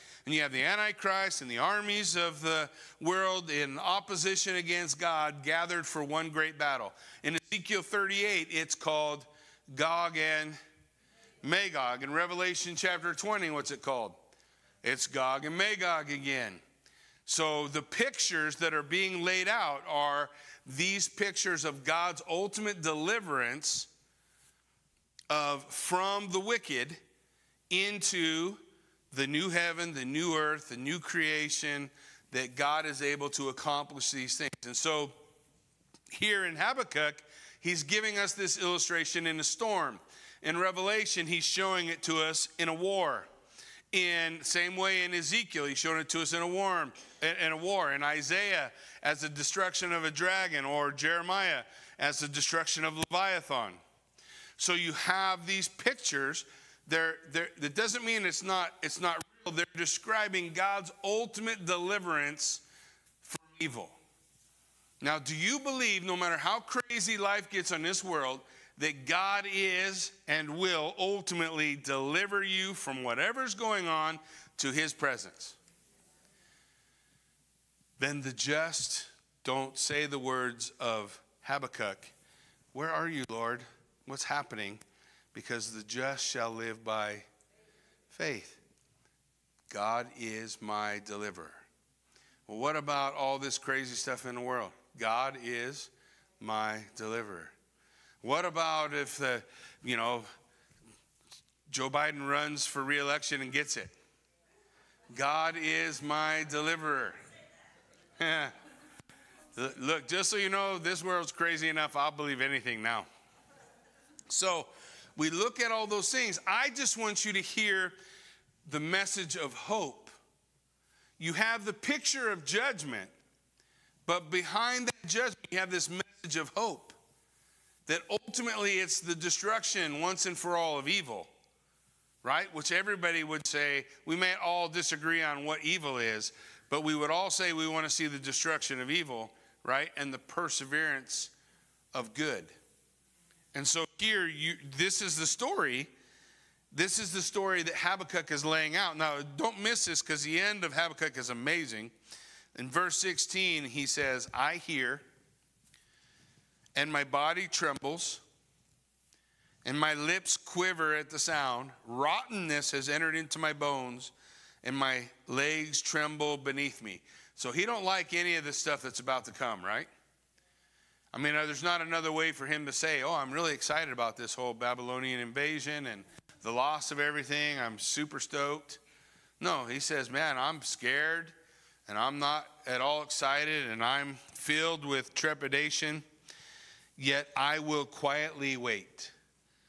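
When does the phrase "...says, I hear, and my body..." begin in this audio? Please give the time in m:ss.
2:33.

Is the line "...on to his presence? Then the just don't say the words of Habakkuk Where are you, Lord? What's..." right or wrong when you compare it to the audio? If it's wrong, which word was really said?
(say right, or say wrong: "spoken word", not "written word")
right.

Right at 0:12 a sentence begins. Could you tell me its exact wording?
In Revelation chapter 20, what's it called?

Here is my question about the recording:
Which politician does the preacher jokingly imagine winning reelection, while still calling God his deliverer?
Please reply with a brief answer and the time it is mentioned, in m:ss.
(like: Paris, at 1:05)
Joe Biden, at 1:41.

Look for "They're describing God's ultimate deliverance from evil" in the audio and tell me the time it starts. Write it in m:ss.
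0:59.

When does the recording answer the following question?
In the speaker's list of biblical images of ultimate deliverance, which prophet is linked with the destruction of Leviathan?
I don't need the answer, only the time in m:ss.
0:50.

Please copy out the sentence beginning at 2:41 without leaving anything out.
Rottenness has entered into my bones, and my legs tremble beneath me.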